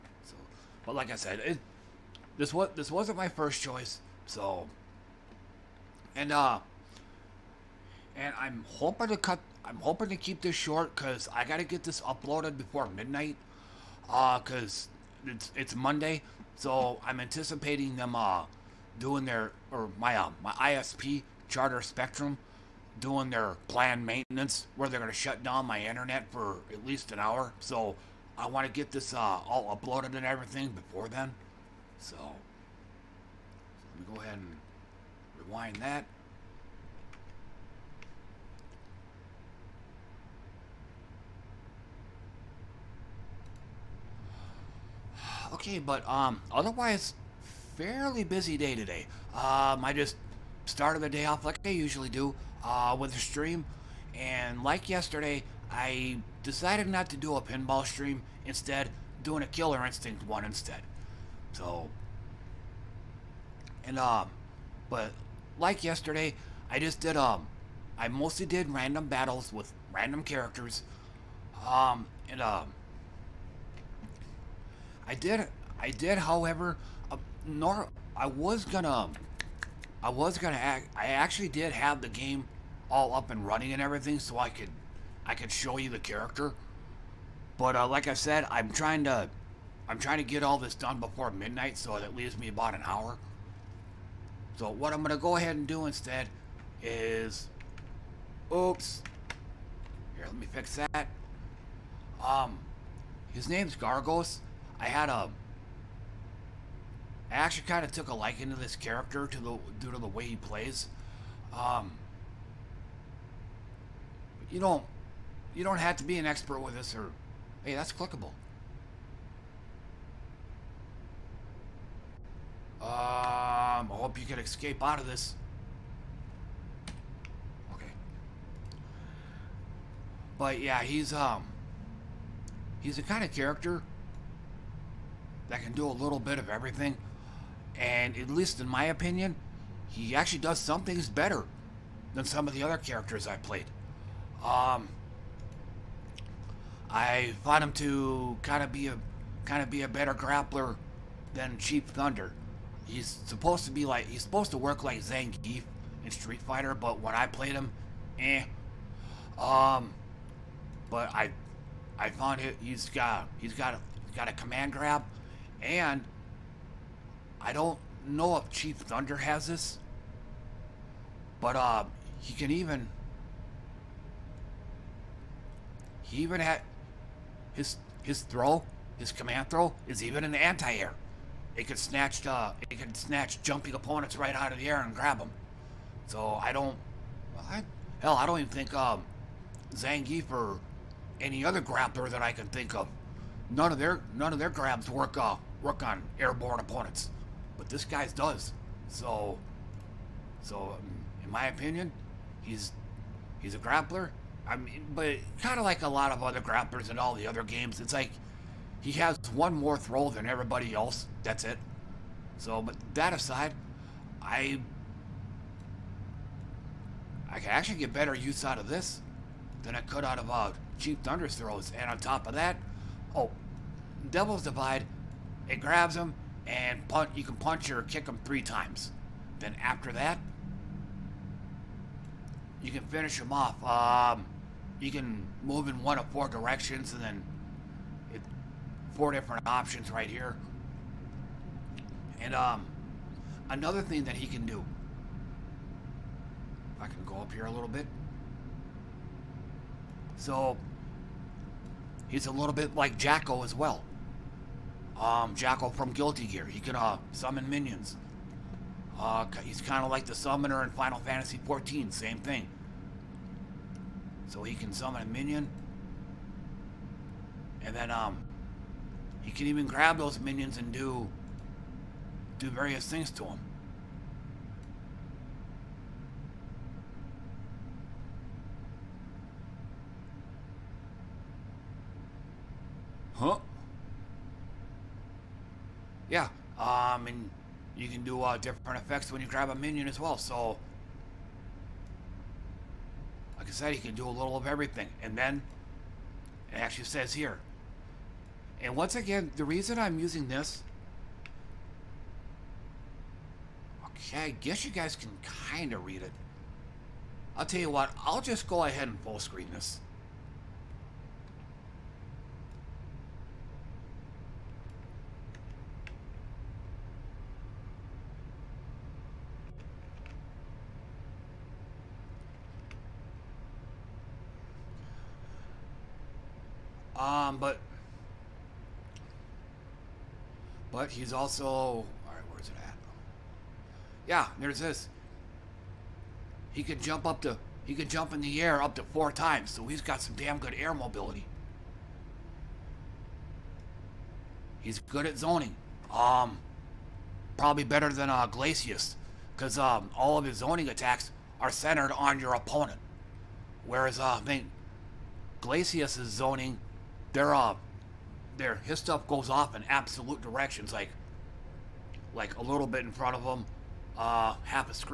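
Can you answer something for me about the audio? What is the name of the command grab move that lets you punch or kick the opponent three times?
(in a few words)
Devil's Divide.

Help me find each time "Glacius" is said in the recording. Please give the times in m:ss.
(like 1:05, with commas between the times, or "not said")
5:48, 5:55.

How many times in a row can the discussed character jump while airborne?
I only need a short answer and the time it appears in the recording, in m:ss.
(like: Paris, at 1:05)
4, at 5:38.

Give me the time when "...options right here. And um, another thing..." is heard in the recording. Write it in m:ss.
3:59.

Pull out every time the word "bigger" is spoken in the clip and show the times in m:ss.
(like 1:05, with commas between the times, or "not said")
not said.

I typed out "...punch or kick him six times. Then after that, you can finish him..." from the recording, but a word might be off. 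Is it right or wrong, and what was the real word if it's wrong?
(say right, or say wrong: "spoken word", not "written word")
wrong: "three", not "six".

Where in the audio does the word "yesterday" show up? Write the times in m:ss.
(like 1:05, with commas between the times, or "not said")
0:54, 1:05.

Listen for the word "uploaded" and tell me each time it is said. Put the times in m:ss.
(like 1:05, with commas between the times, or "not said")
0:12, 0:29.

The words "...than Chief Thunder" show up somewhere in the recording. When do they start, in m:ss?
2:31.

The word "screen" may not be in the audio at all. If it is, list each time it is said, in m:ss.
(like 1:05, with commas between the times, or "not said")
5:09.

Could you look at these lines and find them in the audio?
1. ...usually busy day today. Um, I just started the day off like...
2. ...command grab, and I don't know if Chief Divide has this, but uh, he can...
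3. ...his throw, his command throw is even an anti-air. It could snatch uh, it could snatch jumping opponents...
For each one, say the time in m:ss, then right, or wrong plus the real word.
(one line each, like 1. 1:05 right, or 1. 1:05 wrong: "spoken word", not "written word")
1. 0:47 wrong: "fairly", not "usually"
2. 2:44 wrong: "Thunder", not "Divide"
3. 2:58 right.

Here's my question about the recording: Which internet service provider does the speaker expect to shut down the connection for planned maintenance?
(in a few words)
Charter Spectrum.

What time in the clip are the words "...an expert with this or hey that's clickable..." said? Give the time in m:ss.
1:56.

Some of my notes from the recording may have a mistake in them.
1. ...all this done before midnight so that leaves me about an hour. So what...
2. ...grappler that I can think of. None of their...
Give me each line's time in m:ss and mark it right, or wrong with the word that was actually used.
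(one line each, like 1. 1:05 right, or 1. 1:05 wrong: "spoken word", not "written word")
1. 1:30 right
2. 3:11 right.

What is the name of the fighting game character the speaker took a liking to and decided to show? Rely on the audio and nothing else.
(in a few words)
Gargos.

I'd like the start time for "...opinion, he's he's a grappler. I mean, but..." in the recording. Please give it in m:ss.
3:21.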